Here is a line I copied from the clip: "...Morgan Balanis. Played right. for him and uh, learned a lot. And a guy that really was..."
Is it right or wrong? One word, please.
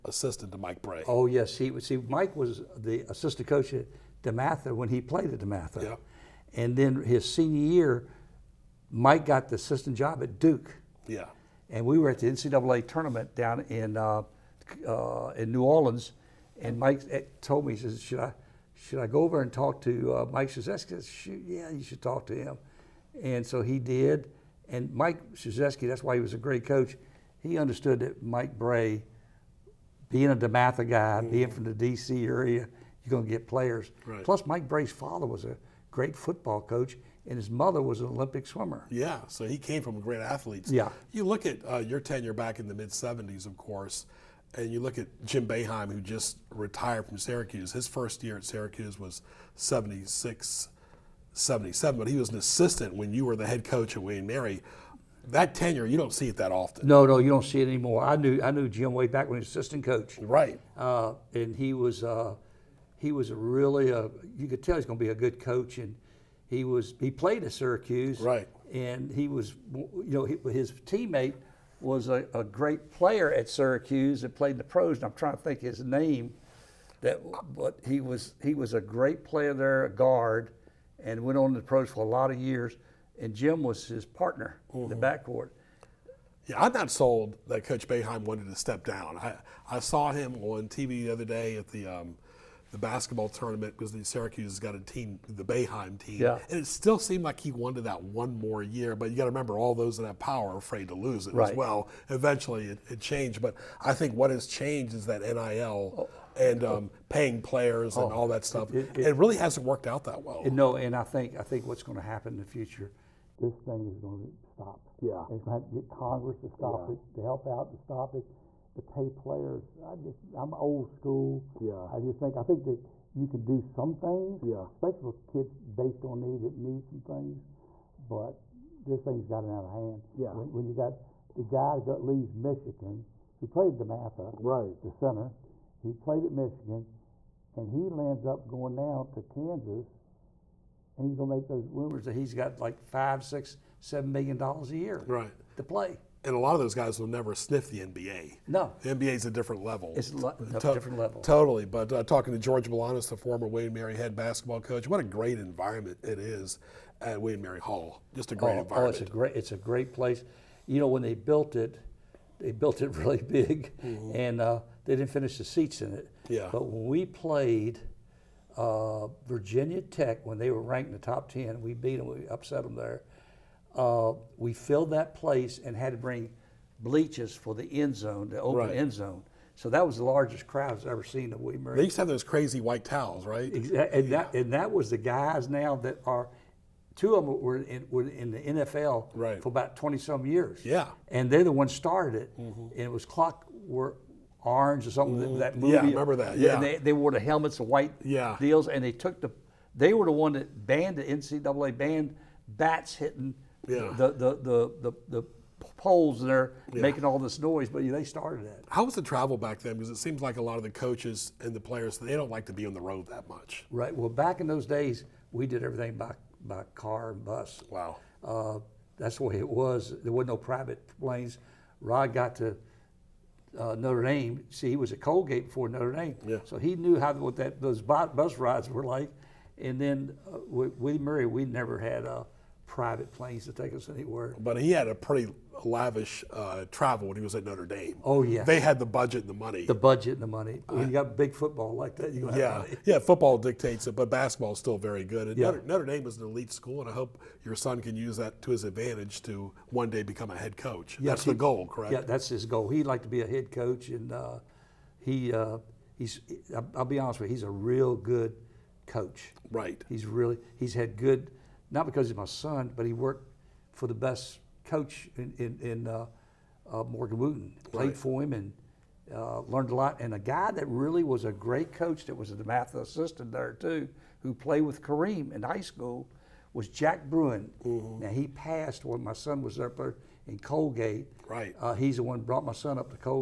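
wrong.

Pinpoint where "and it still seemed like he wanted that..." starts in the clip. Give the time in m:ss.
1:36.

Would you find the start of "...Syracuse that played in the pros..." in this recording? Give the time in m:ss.
1:13.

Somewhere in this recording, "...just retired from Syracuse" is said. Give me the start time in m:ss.
0:45.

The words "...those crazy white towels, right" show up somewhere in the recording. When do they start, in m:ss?
3:02.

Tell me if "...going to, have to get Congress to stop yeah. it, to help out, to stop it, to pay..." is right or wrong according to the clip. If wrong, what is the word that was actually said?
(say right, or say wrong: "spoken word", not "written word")
right.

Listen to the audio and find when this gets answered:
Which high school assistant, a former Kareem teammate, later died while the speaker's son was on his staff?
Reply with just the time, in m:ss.
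4:36.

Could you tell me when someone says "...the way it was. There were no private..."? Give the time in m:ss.
3:39.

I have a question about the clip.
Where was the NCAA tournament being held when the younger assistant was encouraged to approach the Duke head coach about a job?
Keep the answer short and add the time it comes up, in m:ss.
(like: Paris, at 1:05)
New Orleans, at 0:15.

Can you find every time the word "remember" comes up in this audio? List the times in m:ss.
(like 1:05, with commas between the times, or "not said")
1:39, 3:15.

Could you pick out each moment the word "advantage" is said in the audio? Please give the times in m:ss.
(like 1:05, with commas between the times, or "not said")
4:08.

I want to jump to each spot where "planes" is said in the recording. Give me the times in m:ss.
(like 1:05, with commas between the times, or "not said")
3:40, 3:53.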